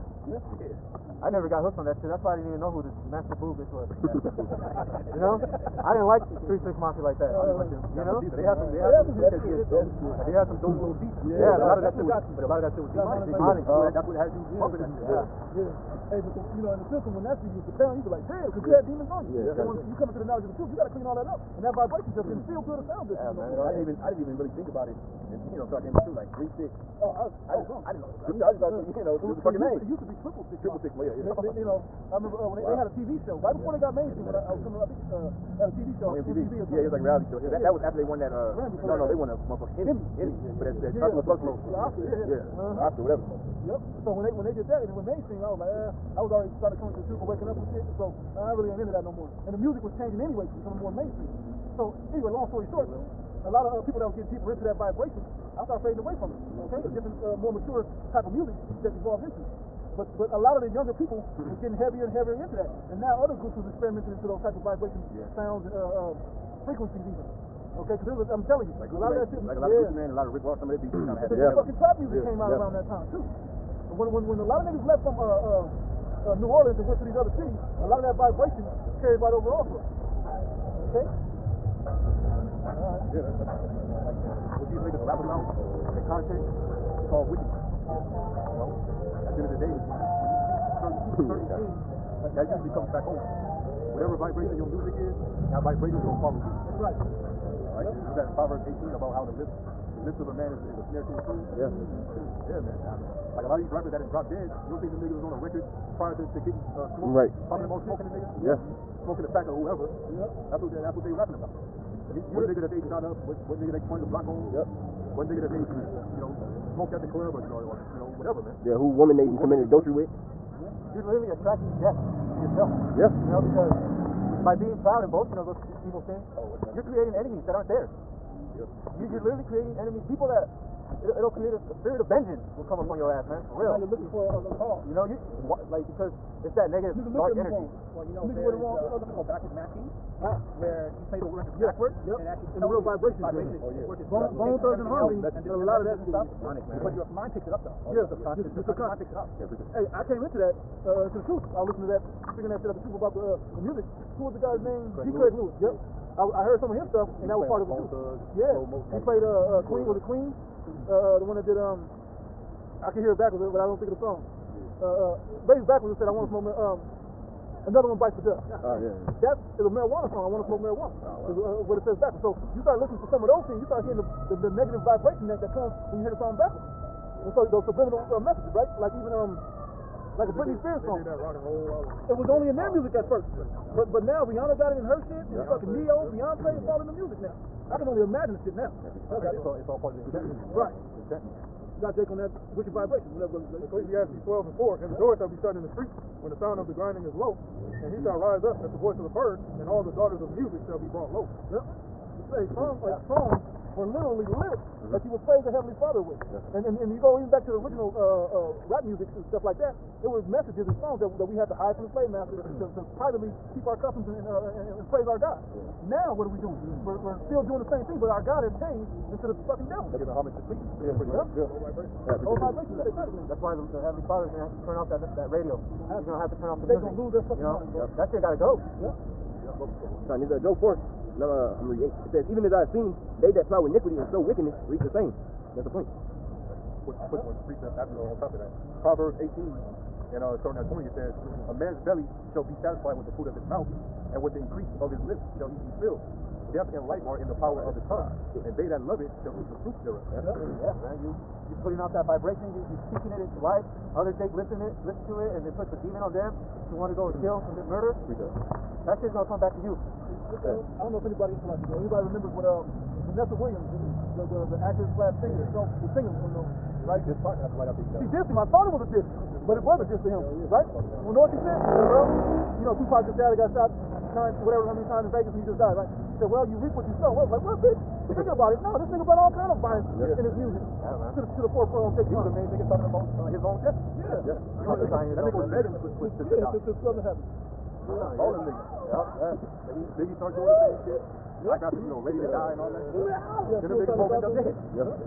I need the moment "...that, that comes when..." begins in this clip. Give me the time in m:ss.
2:55.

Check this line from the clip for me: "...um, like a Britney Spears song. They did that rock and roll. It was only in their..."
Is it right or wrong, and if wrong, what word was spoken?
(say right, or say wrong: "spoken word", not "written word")
right.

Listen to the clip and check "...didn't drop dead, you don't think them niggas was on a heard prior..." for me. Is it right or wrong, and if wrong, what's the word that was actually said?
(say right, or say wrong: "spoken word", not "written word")
wrong: "record", not "heard".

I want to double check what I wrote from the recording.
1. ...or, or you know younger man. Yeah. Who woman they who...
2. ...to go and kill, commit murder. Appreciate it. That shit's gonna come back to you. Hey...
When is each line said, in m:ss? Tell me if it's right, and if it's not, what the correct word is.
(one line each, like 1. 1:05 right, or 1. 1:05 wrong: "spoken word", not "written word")
1. 1:57 wrong: "whatever", not "younger"
2. 4:16 right.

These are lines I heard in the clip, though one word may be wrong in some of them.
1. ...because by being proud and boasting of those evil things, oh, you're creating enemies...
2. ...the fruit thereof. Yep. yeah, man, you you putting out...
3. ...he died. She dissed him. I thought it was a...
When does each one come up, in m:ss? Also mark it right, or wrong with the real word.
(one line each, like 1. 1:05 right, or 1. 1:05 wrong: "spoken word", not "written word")
1. 2:03 right
2. 4:09 right
3. 4:27 right.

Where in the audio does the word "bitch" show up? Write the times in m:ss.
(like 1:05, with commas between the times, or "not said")
0:03, 4:37.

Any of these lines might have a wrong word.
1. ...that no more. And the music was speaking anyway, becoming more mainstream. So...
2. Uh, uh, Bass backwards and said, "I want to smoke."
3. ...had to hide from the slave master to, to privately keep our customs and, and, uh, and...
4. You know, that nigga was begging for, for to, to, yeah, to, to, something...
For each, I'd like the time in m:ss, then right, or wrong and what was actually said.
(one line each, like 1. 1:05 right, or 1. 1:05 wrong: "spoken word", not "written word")
1. 0:48 wrong: "changing", not "speaking"
2. 2:44 right
3. 3:31 right
4. 4:44 right.